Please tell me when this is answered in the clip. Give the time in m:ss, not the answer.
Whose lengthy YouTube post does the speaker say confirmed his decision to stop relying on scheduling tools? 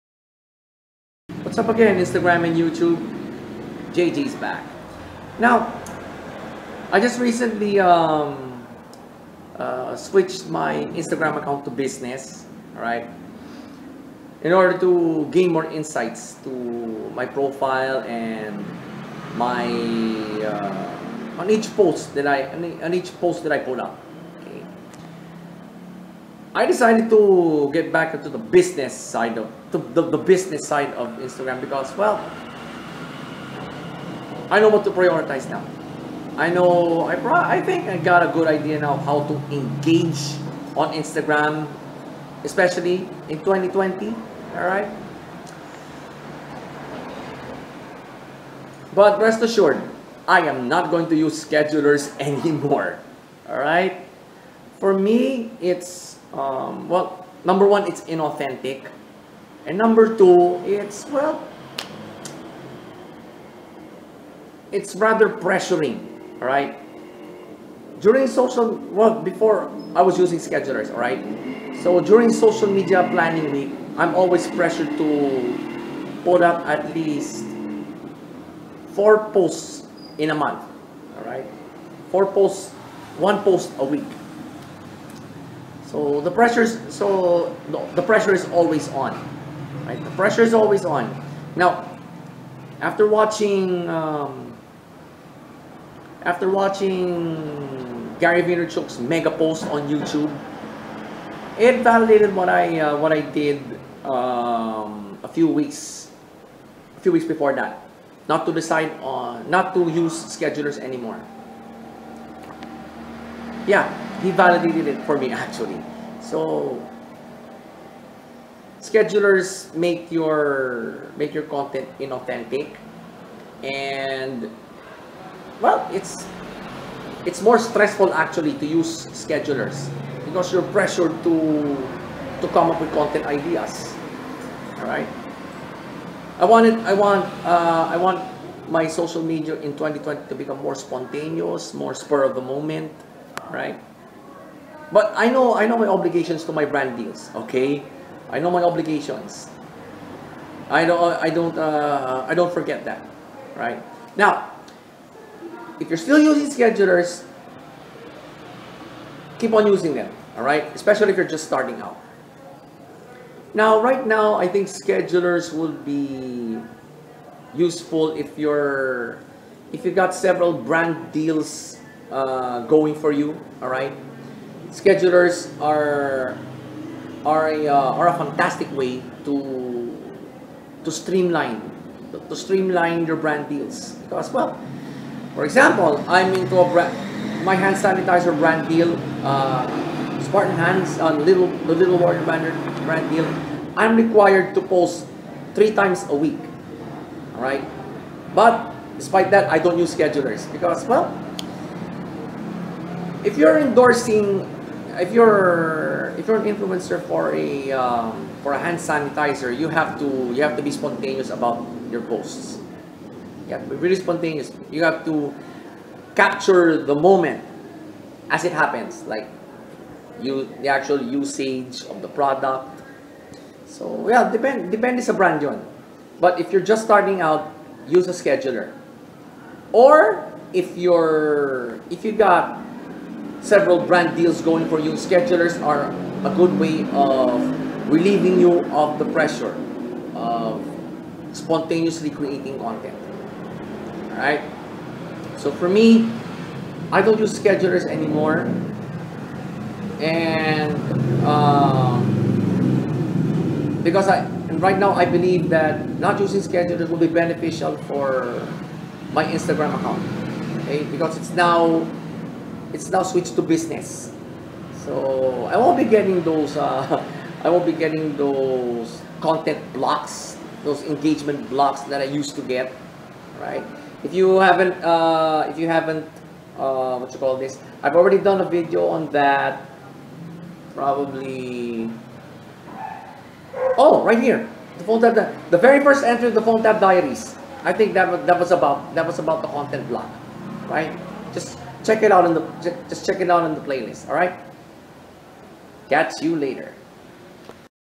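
1:38.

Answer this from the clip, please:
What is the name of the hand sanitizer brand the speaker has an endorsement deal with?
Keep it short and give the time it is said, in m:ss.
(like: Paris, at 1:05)
Spartan Hands On, at 3:10.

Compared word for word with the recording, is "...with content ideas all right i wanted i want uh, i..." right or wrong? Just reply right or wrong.
right.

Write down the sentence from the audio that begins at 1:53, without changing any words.
Yeah, he validated it for me actually.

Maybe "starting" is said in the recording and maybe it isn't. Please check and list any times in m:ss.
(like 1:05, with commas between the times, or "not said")
2:41, 3:46.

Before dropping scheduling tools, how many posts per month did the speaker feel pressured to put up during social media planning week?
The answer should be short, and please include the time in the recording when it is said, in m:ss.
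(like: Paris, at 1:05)
4, at 1:18.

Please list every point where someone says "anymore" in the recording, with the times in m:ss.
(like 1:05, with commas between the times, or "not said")
0:52, 1:50, 4:07.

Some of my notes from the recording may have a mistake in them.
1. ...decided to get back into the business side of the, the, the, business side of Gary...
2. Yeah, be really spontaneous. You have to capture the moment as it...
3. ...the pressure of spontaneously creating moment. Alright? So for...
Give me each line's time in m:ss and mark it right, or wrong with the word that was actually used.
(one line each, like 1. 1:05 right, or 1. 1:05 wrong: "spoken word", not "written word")
1. 0:26 wrong: "Instagram", not "Gary"
2. 3:33 right
3. 3:58 wrong: "content", not "moment".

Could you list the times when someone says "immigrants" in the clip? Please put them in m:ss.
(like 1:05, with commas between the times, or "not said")
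not said.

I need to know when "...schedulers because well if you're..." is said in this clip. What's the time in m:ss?
3:19.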